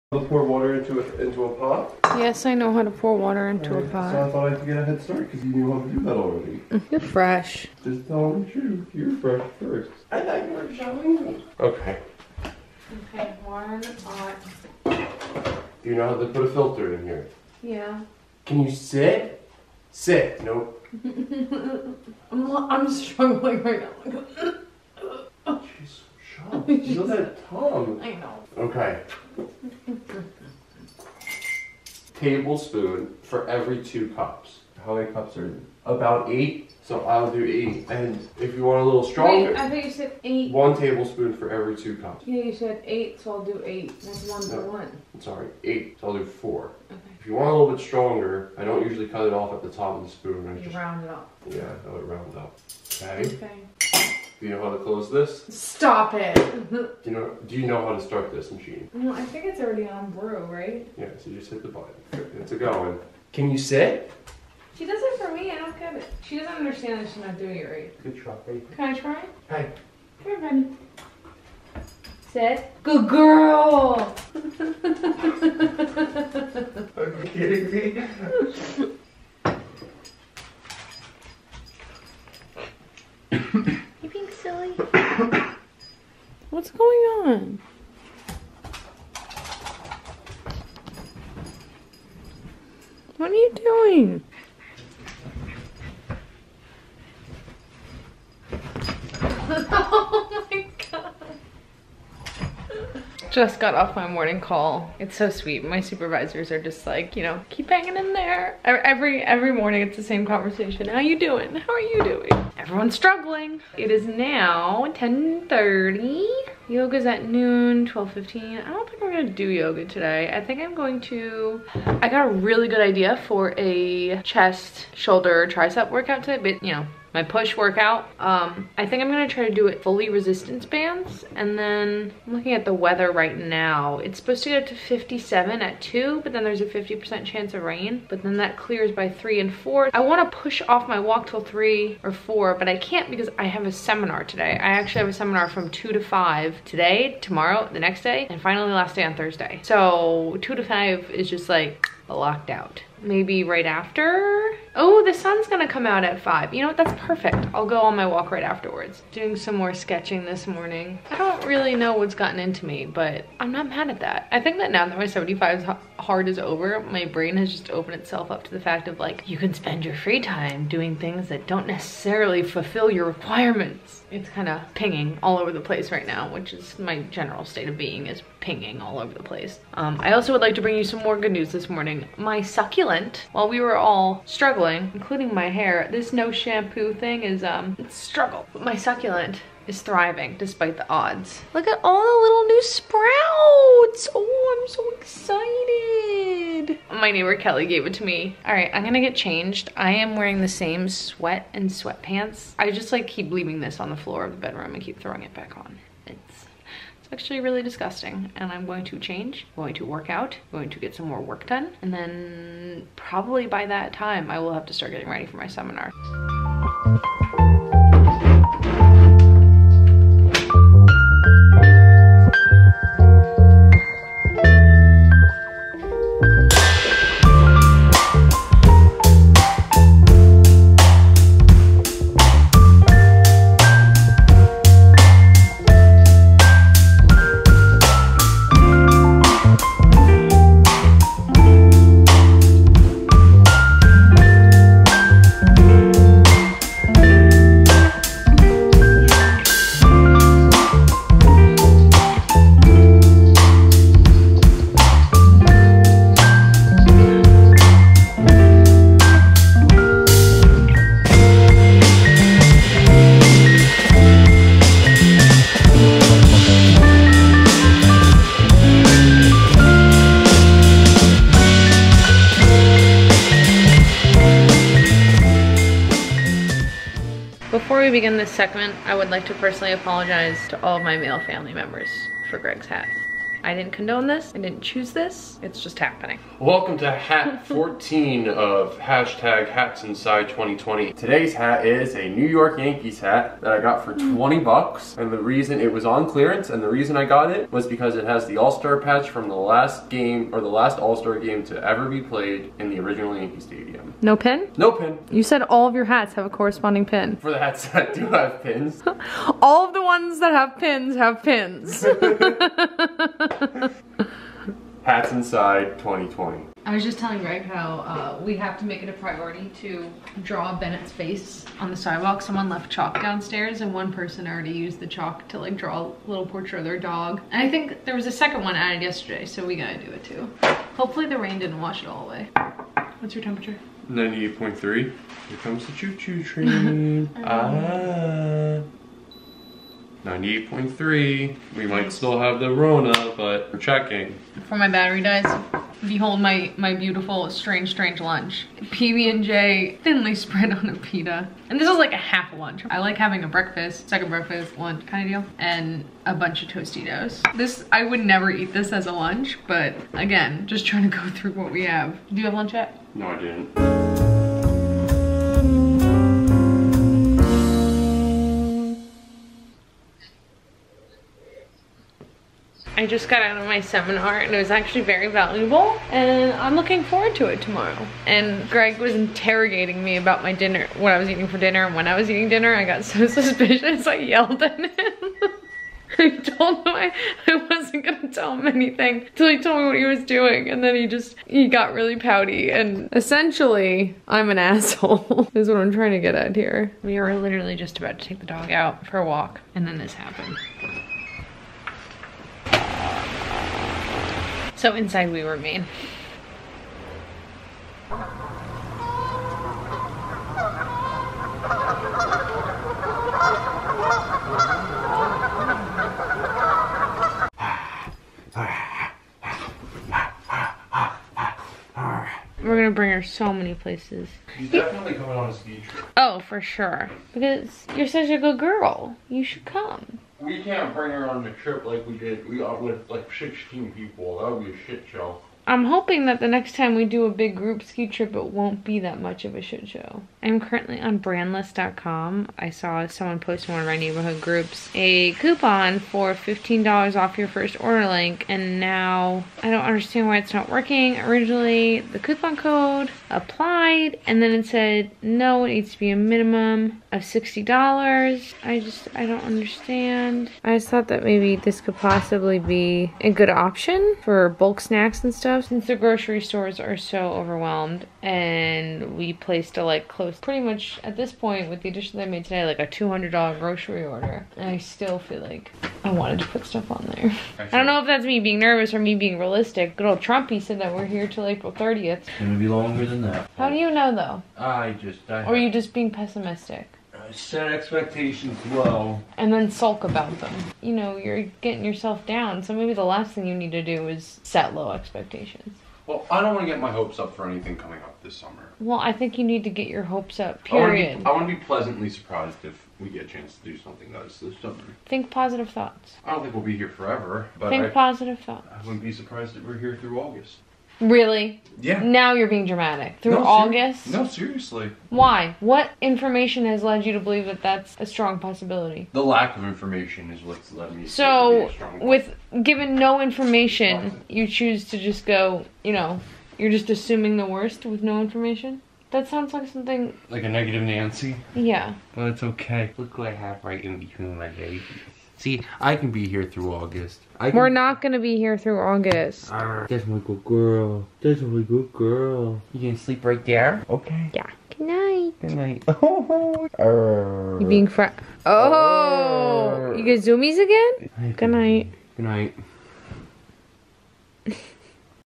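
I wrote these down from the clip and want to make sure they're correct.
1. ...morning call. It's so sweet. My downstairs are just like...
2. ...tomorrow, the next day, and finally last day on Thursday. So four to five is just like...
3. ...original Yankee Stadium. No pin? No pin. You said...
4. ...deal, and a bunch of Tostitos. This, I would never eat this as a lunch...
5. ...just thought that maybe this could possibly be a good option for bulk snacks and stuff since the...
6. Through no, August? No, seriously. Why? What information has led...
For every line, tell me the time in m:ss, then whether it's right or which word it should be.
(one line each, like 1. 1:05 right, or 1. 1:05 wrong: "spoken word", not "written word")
1. 1:44 wrong: "supervisors", not "downstairs"
2. 2:27 wrong: "two", not "four"
3. 5:02 right
4. 5:55 right
5. 7:40 right
6. 8:33 right.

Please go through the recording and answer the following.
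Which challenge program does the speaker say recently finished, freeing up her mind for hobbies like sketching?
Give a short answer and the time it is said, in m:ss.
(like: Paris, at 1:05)
75 Hard, at 2:45.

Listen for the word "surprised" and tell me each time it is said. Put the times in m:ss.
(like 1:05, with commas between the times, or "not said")
8:21, 8:28.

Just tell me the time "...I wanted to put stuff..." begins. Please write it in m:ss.
7:55.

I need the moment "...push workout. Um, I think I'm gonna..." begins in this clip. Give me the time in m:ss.
2:07.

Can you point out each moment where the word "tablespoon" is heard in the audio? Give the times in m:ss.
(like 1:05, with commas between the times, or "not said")
0:32, 0:40.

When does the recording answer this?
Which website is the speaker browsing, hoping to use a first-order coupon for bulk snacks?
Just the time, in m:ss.
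7:20.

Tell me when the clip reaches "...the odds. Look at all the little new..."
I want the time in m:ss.
3:10.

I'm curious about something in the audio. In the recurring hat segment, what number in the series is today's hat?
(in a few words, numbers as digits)
14.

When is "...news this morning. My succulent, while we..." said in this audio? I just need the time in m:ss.
3:01.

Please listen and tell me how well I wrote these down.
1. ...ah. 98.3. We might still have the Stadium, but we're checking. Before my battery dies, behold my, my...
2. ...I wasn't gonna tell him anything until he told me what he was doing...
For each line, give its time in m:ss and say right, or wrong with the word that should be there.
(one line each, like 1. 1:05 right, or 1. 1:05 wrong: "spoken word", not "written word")
1. 5:37 wrong: "Rona", not "Stadium"
2. 6:27 right.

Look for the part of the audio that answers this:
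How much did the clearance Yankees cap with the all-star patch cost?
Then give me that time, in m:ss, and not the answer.
4:54.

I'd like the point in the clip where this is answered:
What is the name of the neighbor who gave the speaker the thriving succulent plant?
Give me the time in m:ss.
3:17.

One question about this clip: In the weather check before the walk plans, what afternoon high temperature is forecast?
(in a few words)
57.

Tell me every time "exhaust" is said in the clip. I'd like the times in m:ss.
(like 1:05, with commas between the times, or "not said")
not said.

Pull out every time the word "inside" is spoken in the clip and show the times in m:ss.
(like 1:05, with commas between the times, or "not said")
4:49, 5:15, 6:44.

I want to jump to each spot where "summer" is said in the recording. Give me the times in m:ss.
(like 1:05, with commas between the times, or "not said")
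8:18, 8:24.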